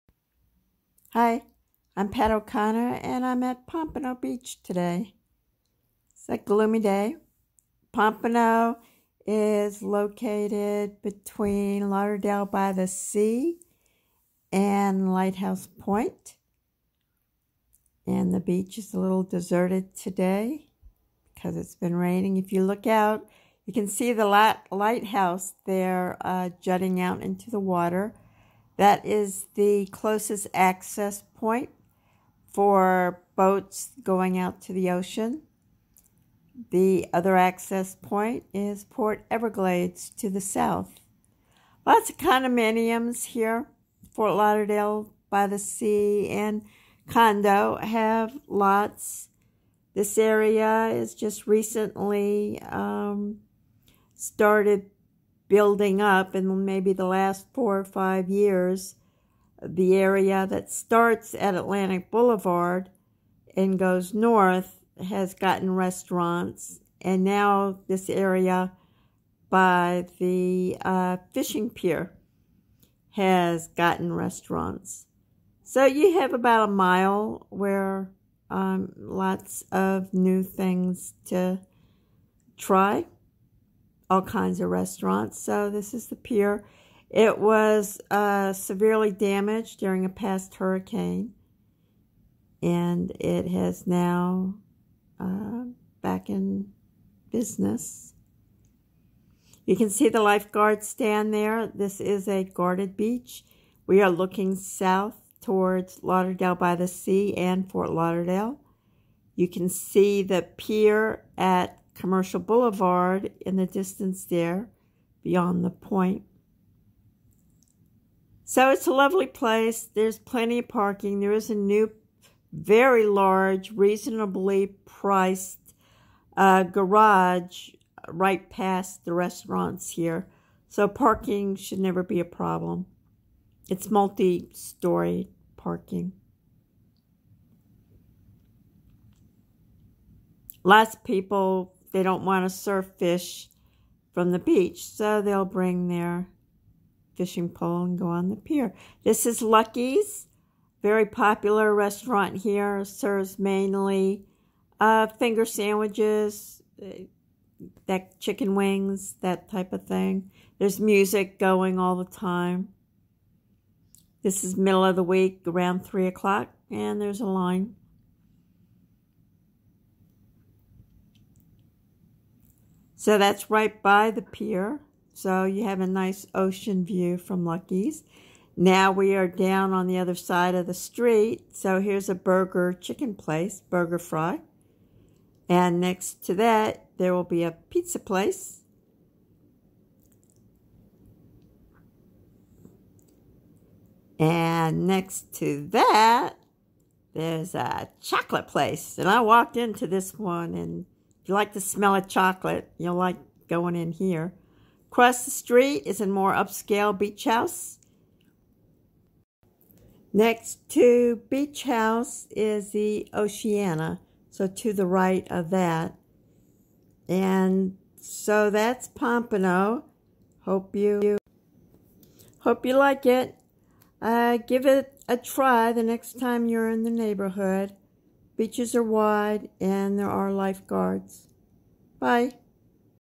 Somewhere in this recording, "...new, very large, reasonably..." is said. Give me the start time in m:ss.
2:01.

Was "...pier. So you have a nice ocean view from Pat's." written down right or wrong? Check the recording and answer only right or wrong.
wrong.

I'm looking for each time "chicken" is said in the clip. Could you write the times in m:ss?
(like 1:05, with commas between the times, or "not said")
2:38, 3:02.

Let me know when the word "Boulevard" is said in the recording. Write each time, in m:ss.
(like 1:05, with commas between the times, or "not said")
1:02, 1:52.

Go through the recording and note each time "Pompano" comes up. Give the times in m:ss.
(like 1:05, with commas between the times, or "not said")
0:03, 0:07, 3:38.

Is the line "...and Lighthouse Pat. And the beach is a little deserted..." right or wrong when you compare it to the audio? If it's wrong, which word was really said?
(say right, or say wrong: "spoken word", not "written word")
wrong: "Point", not "Pat".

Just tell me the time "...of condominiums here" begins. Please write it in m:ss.
0:42.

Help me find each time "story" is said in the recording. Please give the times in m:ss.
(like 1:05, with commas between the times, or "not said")
2:13.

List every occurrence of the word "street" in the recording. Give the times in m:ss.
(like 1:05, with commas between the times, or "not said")
3:00, 3:25.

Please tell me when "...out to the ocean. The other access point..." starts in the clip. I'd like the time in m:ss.
0:34.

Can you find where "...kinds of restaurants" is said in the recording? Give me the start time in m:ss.
1:24.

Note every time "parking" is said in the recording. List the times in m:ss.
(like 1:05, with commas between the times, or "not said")
2:00, 2:10, 2:15.